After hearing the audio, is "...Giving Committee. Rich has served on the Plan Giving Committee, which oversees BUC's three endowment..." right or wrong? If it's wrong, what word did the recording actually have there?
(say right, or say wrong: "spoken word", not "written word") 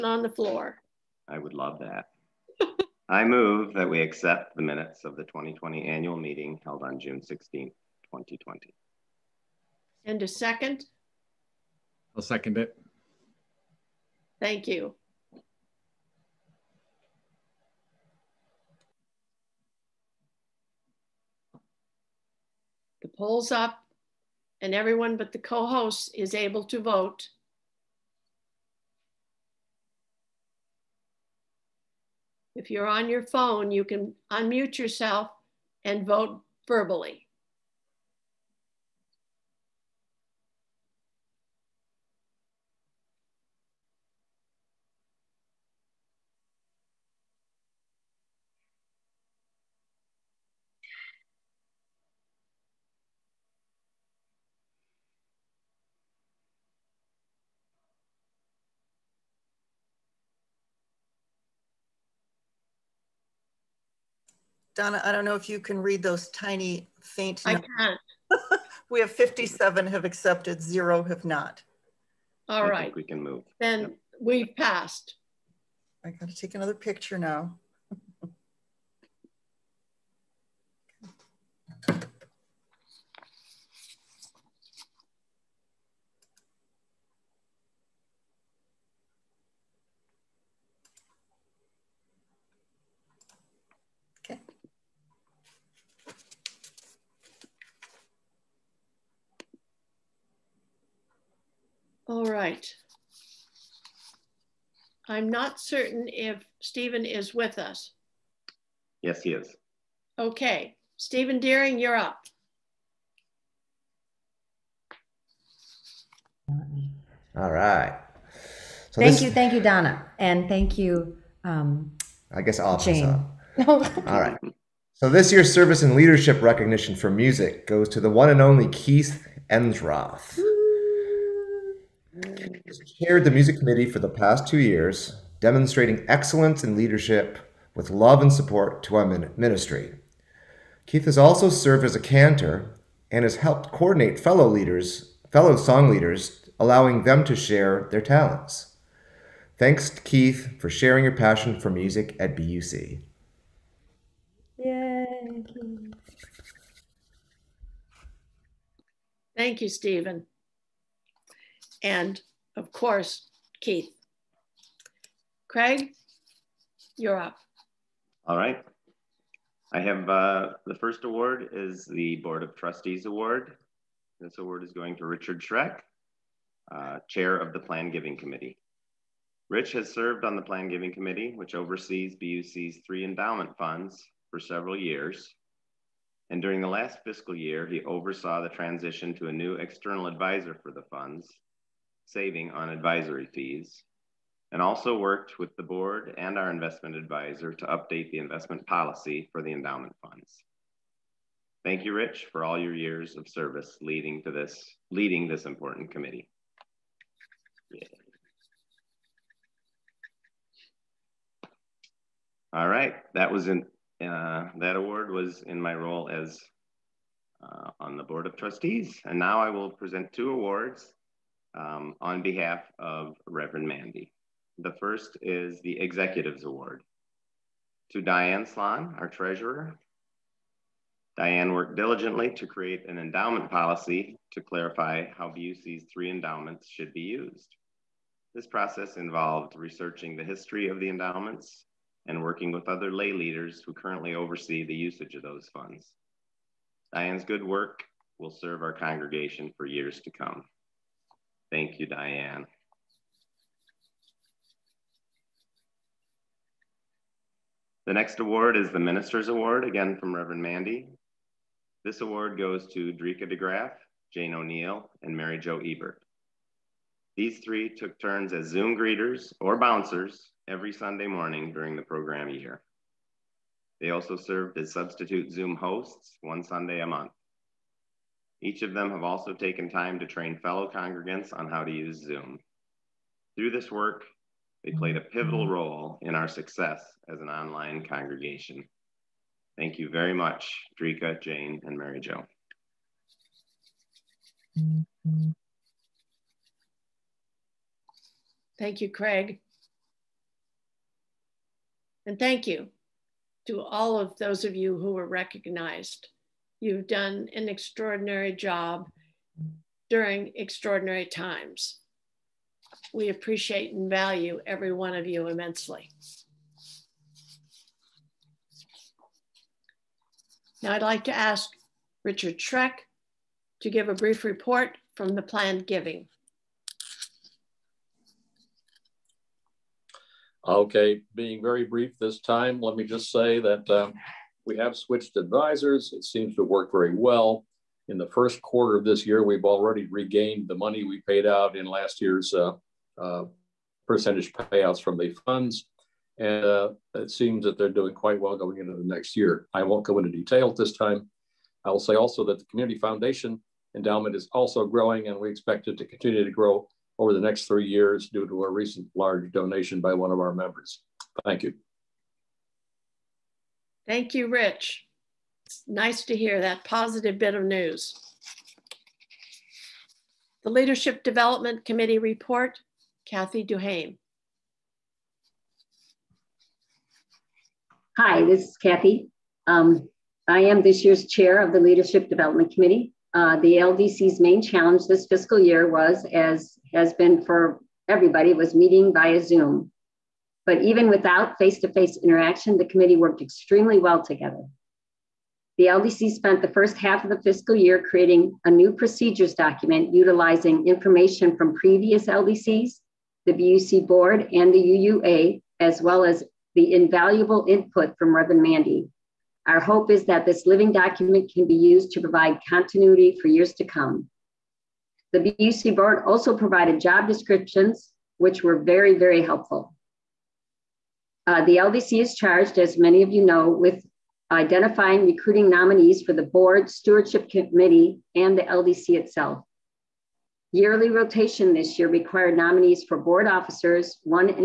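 right.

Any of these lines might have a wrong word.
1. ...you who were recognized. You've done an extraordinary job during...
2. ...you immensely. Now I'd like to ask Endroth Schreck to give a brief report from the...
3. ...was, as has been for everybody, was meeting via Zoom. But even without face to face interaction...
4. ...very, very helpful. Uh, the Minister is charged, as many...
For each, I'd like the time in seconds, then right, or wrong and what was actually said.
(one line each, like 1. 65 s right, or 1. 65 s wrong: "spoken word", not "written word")
1. 304 s right
2. 315 s wrong: "Richard", not "Endroth"
3. 385 s right
4. 418 s wrong: "LDC", not "Minister".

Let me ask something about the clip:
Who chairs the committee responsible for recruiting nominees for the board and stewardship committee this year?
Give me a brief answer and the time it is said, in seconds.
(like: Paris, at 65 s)
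Kathy Duhame, at 373 s.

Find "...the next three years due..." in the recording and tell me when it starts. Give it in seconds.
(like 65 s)
357 s.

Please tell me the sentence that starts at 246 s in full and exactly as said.
Diane's good work will serve our congregation for years to come.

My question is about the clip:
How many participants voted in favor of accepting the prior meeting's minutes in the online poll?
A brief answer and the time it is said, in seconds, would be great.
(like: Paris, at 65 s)
57, at 69 s.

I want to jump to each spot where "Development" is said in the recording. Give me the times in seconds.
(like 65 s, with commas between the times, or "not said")
371 s, 382 s.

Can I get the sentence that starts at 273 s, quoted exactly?
They also served as substitute Zoom hosts one Sunday a month.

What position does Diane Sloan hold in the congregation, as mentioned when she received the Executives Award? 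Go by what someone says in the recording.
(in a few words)
Treasurer.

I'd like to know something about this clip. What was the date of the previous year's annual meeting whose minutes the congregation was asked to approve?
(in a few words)
June 16, 2020.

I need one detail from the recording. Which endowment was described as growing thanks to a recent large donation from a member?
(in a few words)
Community Foundation endowment.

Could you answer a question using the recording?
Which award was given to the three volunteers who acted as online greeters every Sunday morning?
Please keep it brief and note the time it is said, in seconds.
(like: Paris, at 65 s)
Minister's Award, at 258 s.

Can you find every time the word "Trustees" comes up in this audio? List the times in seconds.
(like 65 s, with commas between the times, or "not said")
172 s, 218 s.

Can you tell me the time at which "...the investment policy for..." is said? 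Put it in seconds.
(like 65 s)
198 s.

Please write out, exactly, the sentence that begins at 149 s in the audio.
Thanks to Keith for sharing your passion for music at BUC.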